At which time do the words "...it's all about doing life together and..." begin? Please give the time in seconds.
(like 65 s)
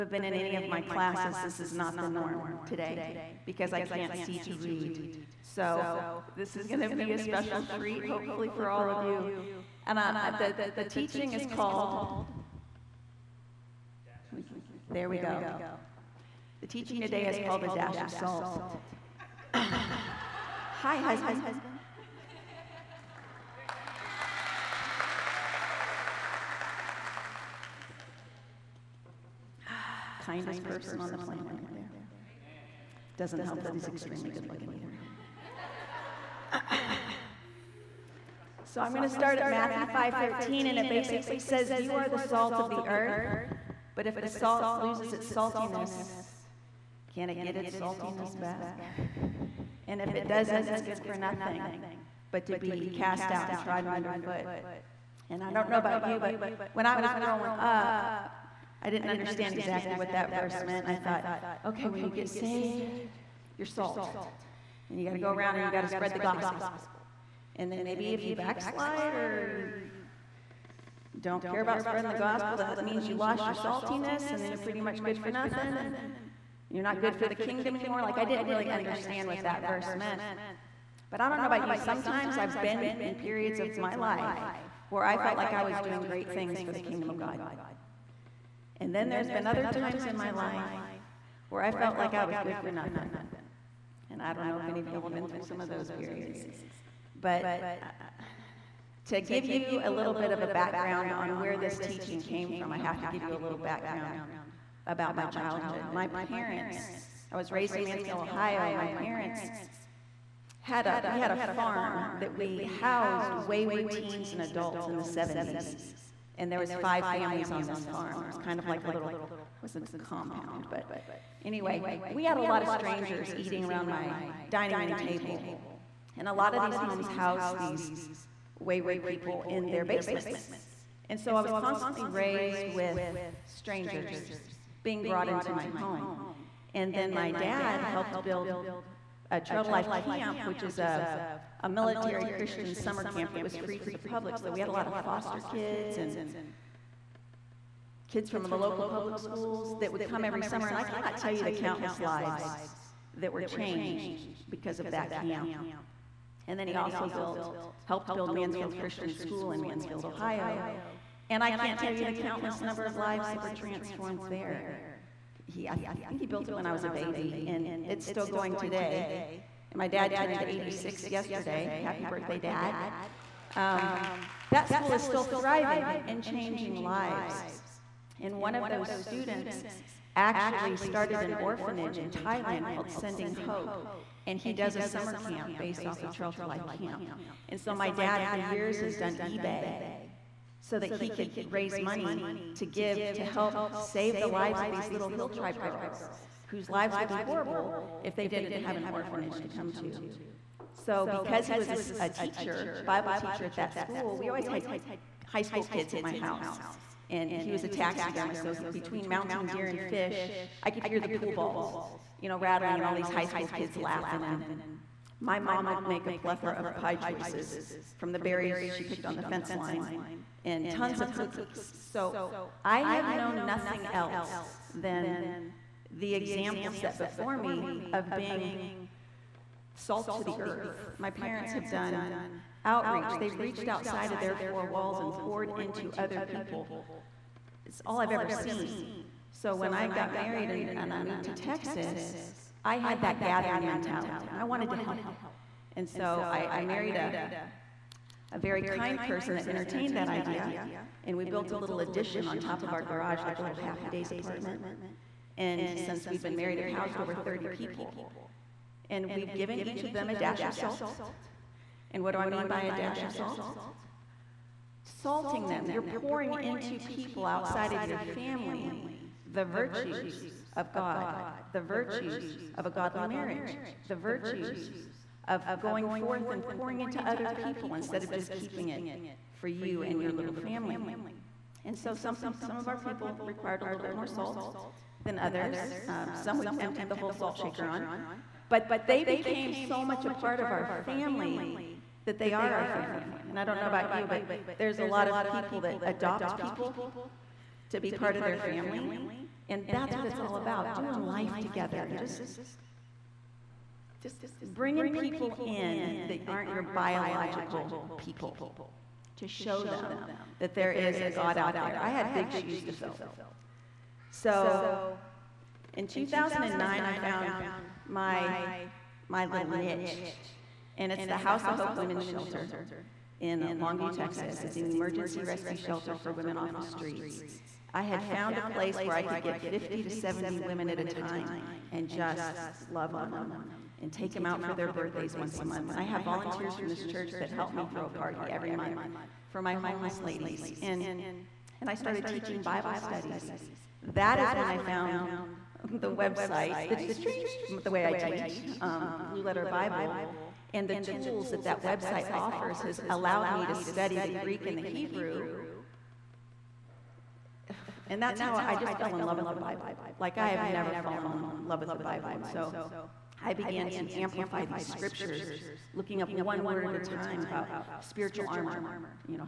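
300 s.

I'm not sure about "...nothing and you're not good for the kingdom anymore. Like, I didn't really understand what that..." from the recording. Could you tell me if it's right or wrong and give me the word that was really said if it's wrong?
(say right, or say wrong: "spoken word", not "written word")
right.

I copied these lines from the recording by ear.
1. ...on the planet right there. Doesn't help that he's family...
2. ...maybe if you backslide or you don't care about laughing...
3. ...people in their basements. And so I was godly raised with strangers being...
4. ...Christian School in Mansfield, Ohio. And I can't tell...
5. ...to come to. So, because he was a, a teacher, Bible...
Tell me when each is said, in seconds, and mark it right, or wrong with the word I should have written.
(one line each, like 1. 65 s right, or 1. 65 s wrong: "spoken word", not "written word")
1. 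31 s wrong: "extremely", not "family"
2. 67 s wrong: "spreading", not "laughing"
3. 129 s wrong: "constantly", not "godly"
4. 158 s right
5. 199 s right.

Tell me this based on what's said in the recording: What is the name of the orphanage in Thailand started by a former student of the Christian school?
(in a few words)
Sending Hope.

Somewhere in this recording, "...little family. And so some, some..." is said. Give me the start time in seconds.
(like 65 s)
280 s.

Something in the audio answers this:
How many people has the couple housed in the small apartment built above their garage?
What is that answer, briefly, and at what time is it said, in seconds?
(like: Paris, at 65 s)
over 30, at 257 s.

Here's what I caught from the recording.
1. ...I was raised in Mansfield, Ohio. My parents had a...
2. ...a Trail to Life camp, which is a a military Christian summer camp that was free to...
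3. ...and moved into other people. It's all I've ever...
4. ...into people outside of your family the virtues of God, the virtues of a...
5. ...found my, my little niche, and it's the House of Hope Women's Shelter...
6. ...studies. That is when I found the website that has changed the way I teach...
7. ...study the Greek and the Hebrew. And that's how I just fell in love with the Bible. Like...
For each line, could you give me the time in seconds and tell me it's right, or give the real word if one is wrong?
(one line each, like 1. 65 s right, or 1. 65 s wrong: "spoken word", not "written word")
1. 107 s right
2. 139 s right
3. 235 s wrong: "poured", not "moved"
4. 266 s right
5. 316 s right
6. 342 s right
7. 353 s right.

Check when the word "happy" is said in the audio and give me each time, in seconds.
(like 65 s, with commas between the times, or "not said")
171 s, 253 s.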